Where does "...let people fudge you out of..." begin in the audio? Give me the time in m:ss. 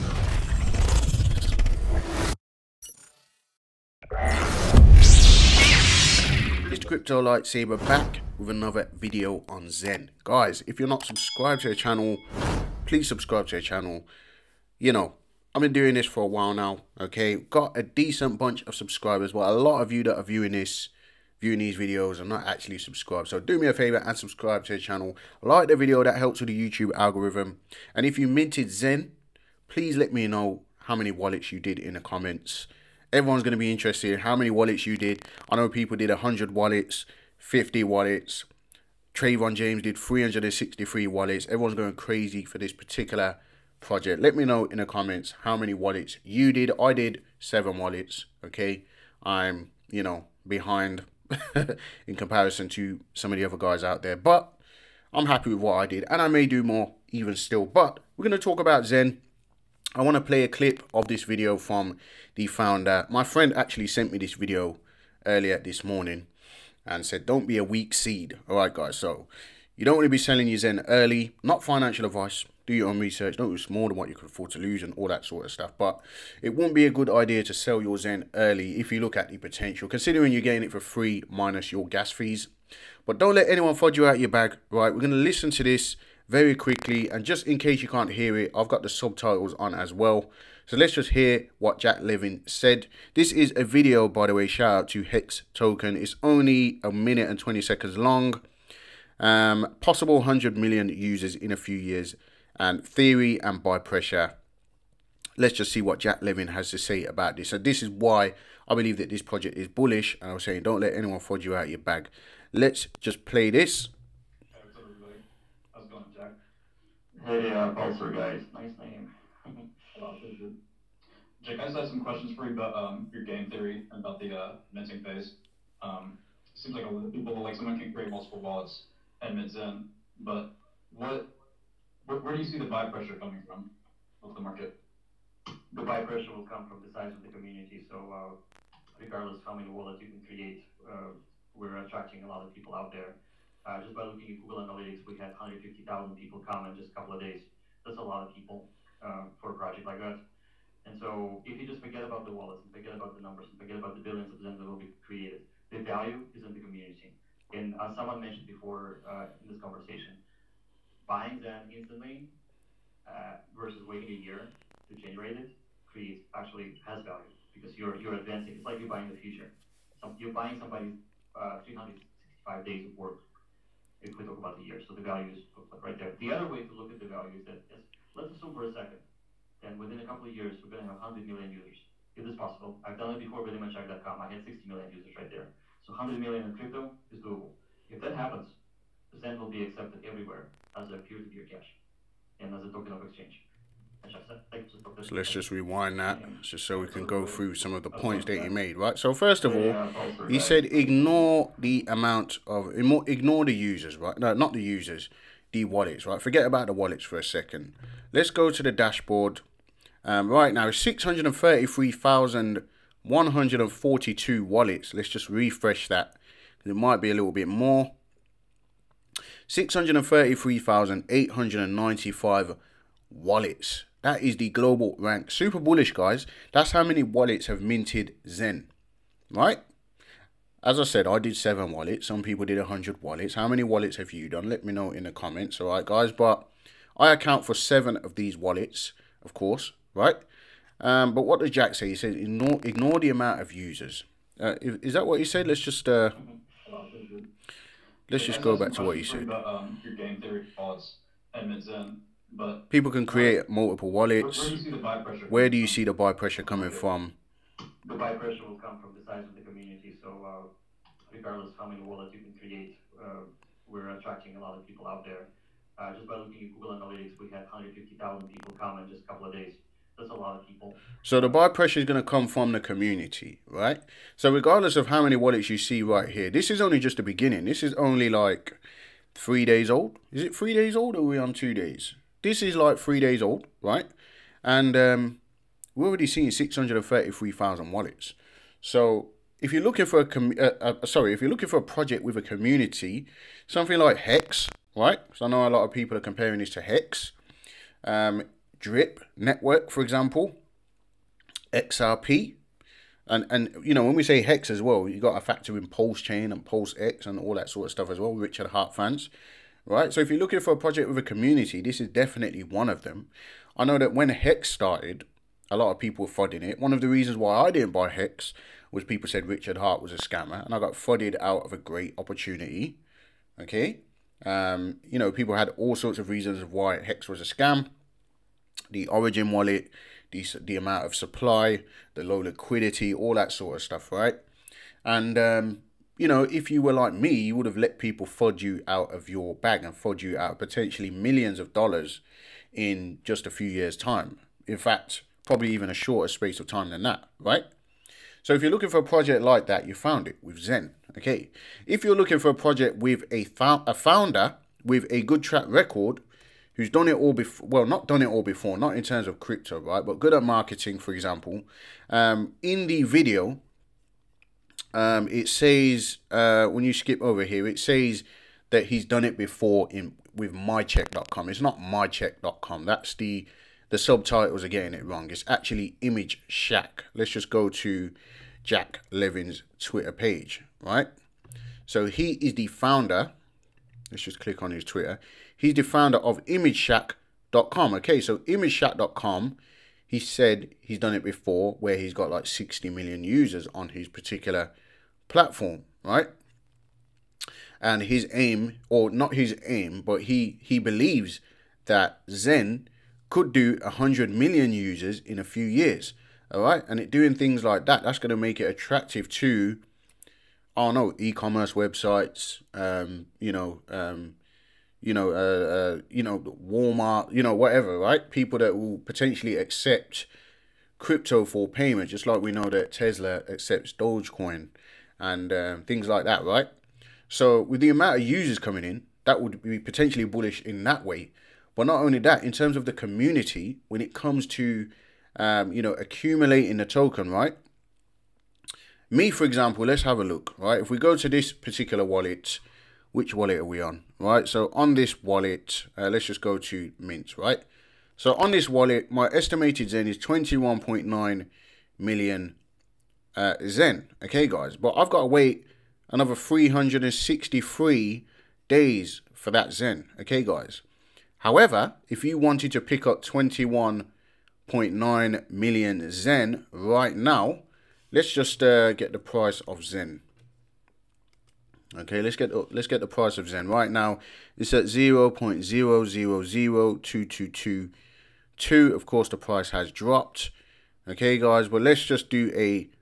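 5:37.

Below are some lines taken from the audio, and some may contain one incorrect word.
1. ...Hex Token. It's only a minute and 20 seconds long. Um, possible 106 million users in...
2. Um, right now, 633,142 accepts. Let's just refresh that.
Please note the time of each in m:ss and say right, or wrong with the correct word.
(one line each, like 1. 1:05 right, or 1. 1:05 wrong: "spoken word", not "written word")
1. 1:35 wrong: "100", not "106"
2. 3:30 wrong: "wallets", not "accepts".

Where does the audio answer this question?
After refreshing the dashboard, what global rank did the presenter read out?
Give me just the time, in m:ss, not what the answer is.
3:39.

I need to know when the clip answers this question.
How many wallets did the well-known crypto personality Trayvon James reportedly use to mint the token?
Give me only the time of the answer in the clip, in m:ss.
0:39.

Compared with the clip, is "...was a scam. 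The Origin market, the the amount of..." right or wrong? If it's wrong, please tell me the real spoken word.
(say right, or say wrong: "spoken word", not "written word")
wrong: "wallet", not "market".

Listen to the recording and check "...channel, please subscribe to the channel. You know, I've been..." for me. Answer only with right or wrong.
right.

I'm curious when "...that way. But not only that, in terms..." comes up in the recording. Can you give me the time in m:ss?
7:10.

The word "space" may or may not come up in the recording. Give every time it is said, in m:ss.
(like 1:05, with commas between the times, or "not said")
5:46.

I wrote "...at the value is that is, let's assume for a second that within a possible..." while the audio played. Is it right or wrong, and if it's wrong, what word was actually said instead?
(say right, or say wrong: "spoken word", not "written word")
wrong: "couple", not "possible".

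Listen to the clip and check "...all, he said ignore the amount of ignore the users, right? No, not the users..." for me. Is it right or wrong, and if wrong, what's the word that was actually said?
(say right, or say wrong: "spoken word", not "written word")
right.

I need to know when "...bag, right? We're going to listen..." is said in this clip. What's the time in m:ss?
1:24.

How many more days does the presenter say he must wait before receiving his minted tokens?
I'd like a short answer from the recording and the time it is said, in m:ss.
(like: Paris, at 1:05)
363, at 7:36.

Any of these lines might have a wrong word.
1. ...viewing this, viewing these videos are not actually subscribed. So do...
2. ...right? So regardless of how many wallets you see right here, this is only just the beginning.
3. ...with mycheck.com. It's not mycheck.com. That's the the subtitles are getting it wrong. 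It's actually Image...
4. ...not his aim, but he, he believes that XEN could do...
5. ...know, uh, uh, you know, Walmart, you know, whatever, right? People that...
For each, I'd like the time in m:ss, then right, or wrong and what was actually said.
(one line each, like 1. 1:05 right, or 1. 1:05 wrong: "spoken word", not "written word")
1. 0:20 right
2. 4:33 right
3. 6:10 right
4. 6:38 right
5. 6:54 right.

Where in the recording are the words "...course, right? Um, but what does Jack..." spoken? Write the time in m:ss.
3:59.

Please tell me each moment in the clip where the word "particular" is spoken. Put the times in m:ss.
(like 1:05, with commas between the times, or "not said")
0:42, 6:33, 7:21.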